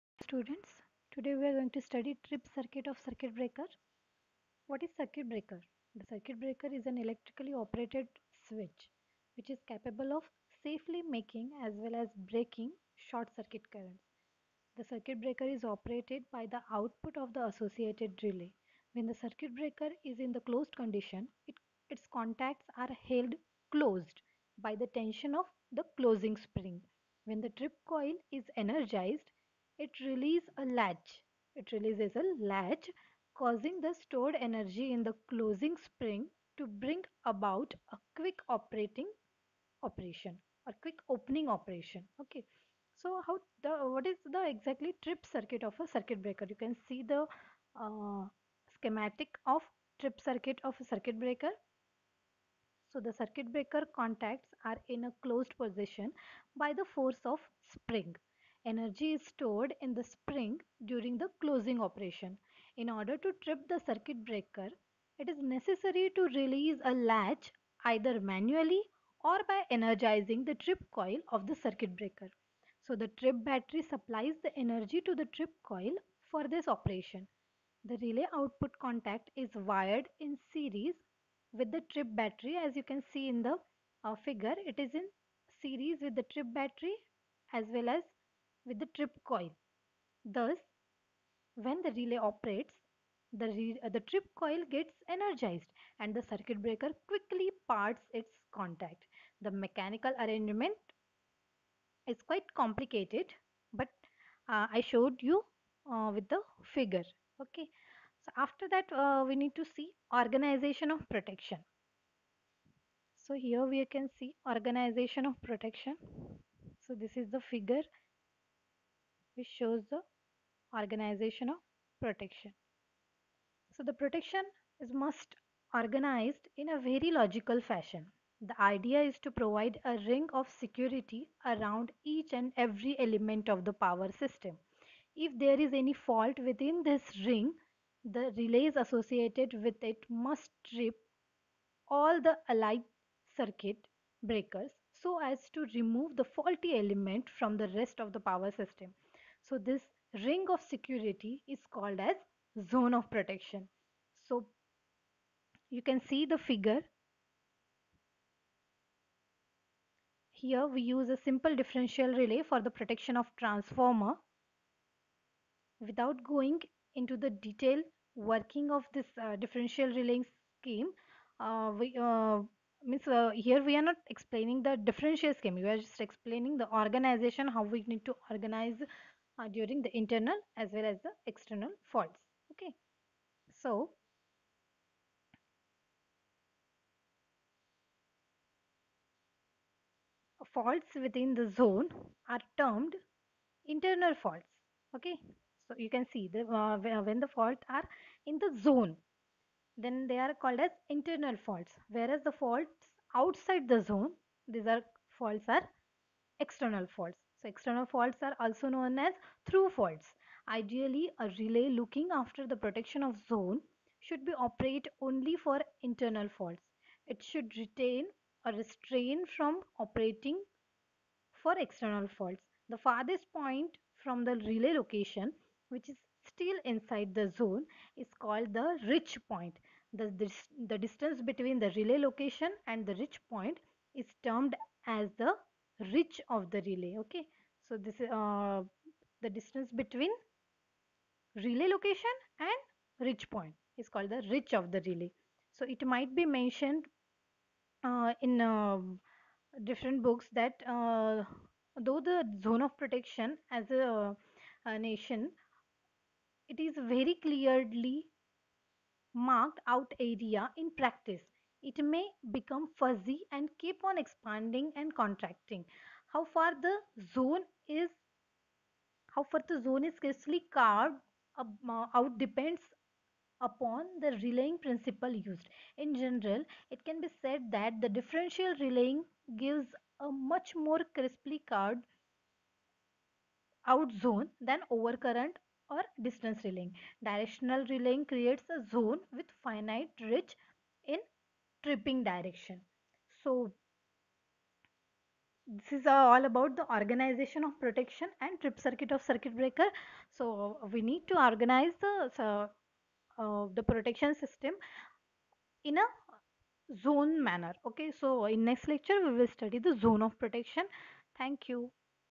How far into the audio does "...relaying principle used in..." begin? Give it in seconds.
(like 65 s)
274 s.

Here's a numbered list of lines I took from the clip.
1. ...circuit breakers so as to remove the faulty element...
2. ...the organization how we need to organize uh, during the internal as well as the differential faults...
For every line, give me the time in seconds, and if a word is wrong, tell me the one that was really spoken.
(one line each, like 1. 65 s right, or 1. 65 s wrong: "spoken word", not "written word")
1. 143 s right
2. 176 s wrong: "external", not "differential".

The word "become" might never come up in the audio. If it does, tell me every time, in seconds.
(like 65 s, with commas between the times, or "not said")
262 s.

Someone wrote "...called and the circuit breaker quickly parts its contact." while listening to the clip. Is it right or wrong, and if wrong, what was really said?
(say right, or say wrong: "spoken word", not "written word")
wrong: "energized", not "called".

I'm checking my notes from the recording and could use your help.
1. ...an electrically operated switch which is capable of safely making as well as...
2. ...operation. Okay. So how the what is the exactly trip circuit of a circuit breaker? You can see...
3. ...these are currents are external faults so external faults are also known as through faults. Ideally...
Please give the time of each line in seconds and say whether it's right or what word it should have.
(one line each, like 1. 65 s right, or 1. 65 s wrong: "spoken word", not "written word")
1. 6 s right
2. 41 s right
3. 204 s wrong: "faults", not "currents".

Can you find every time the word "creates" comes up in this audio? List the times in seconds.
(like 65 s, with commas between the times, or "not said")
288 s.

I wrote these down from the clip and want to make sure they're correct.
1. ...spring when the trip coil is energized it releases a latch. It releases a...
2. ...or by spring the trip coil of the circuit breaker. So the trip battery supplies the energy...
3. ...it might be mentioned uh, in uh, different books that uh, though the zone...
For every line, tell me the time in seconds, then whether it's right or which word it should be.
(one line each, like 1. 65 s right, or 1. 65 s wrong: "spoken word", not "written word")
1. 26 s right
2. 69 s wrong: "energizing", not "spring"
3. 245 s right.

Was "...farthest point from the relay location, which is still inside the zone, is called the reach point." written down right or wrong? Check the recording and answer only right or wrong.
right.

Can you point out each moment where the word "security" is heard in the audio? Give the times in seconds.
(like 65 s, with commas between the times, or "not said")
130 s, 150 s.